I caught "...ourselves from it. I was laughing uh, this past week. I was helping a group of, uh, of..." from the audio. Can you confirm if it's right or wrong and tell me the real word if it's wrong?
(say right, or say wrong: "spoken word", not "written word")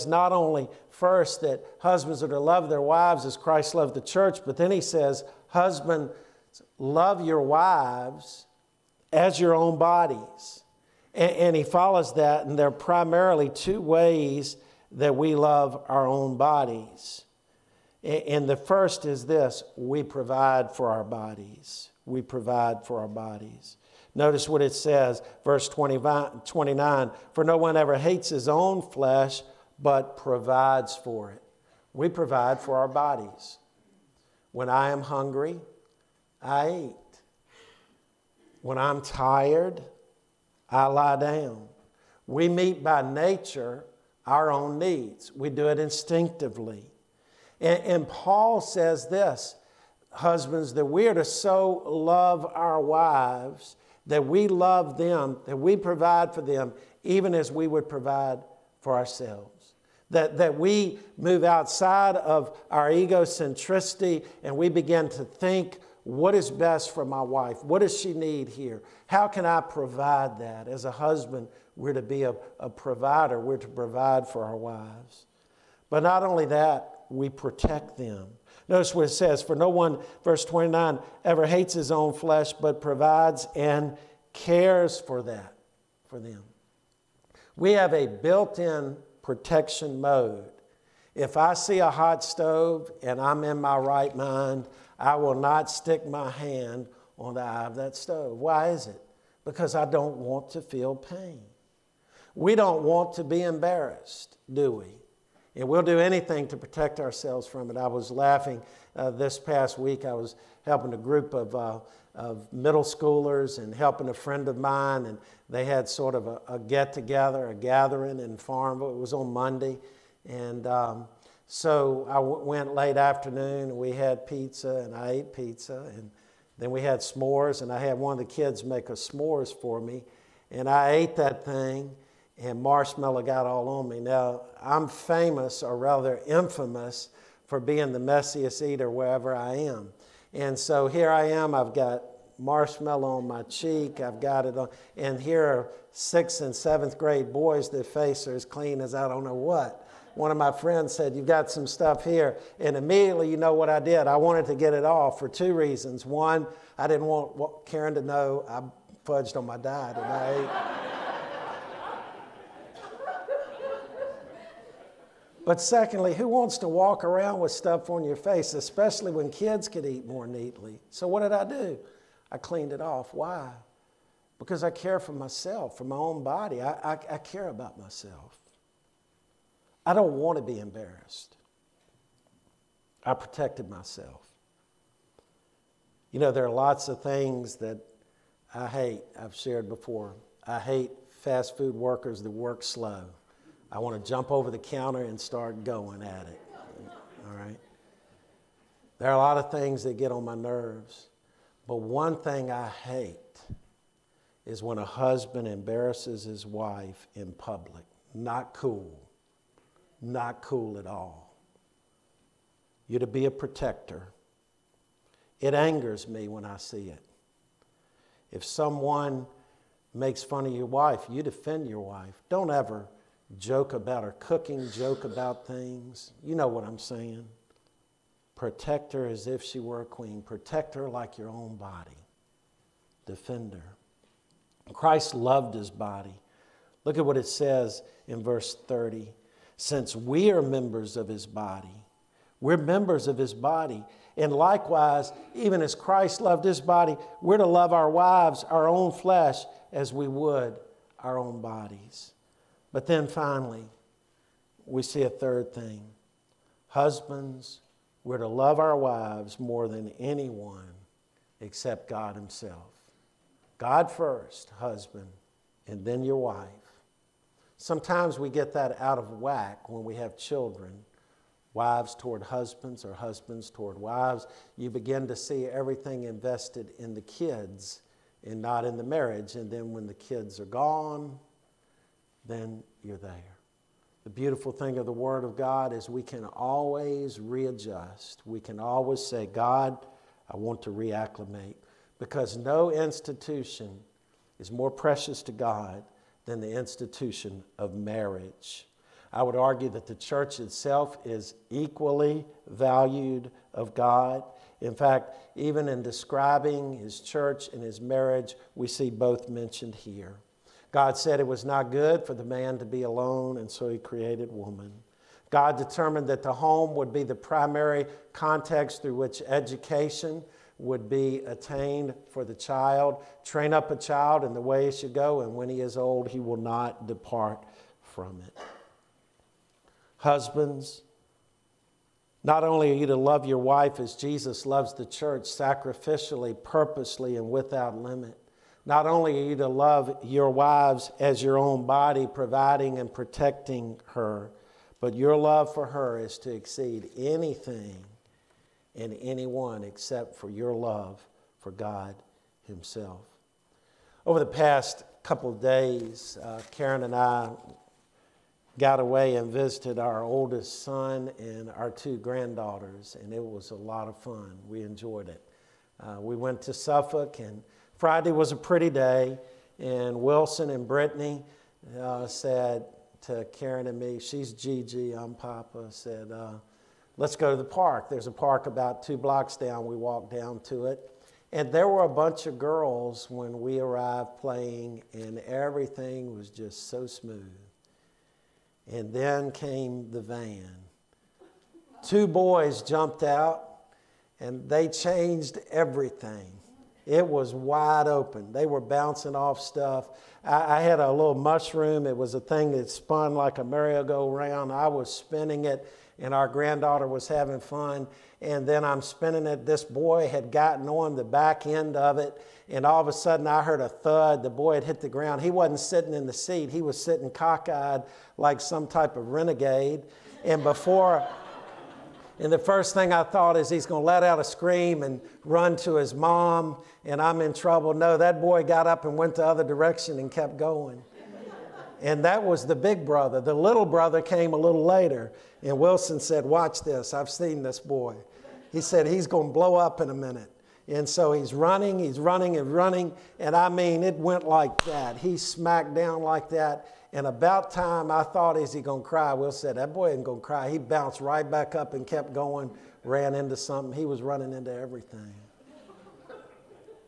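right.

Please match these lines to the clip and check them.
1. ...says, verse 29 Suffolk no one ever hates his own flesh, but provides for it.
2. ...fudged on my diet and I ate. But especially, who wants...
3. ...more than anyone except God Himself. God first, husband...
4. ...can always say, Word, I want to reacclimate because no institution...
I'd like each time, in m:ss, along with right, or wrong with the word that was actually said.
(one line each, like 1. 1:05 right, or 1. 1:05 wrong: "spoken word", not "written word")
1. 0:24 wrong: "For", not "Suffolk"
2. 2:39 wrong: "secondly", not "especially"
3. 4:19 right
4. 4:48 wrong: "God", not "Word".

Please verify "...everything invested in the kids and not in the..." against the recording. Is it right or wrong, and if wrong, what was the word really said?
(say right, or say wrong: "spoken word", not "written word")
right.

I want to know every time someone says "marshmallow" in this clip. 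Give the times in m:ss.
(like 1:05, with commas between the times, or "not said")
2:12, 2:22.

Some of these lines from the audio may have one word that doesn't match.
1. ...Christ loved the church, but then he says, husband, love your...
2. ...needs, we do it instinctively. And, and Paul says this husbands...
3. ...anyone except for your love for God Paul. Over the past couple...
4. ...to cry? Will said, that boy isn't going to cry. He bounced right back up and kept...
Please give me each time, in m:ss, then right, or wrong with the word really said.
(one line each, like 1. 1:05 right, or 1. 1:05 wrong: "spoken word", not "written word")
1. 0:03 right
2. 0:44 right
3. 5:48 wrong: "Himself", not "Paul"
4. 7:28 right.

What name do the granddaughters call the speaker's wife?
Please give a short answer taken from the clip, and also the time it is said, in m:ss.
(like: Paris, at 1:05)
Gigi, at 6:14.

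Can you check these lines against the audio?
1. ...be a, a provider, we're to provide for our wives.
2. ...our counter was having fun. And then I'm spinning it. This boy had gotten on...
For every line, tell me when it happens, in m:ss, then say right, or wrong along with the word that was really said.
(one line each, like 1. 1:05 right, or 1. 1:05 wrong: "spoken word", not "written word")
1. 1:12 right
2. 6:46 wrong: "granddaughter", not "counter".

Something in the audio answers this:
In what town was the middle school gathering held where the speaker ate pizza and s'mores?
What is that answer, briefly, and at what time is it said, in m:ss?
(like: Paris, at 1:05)
Farmville, at 1:58.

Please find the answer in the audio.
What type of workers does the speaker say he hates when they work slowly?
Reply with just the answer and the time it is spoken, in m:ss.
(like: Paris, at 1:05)
Fast food workers, at 3:11.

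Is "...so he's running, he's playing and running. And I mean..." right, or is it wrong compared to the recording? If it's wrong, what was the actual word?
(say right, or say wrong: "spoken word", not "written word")
wrong: "running", not "playing".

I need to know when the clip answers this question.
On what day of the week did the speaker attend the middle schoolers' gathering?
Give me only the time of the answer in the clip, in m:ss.
1:59.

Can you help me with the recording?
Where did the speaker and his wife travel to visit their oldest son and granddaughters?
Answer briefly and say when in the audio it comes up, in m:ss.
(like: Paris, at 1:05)
Suffolk, at 6:06.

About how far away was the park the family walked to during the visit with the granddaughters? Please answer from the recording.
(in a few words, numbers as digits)
2 blocks.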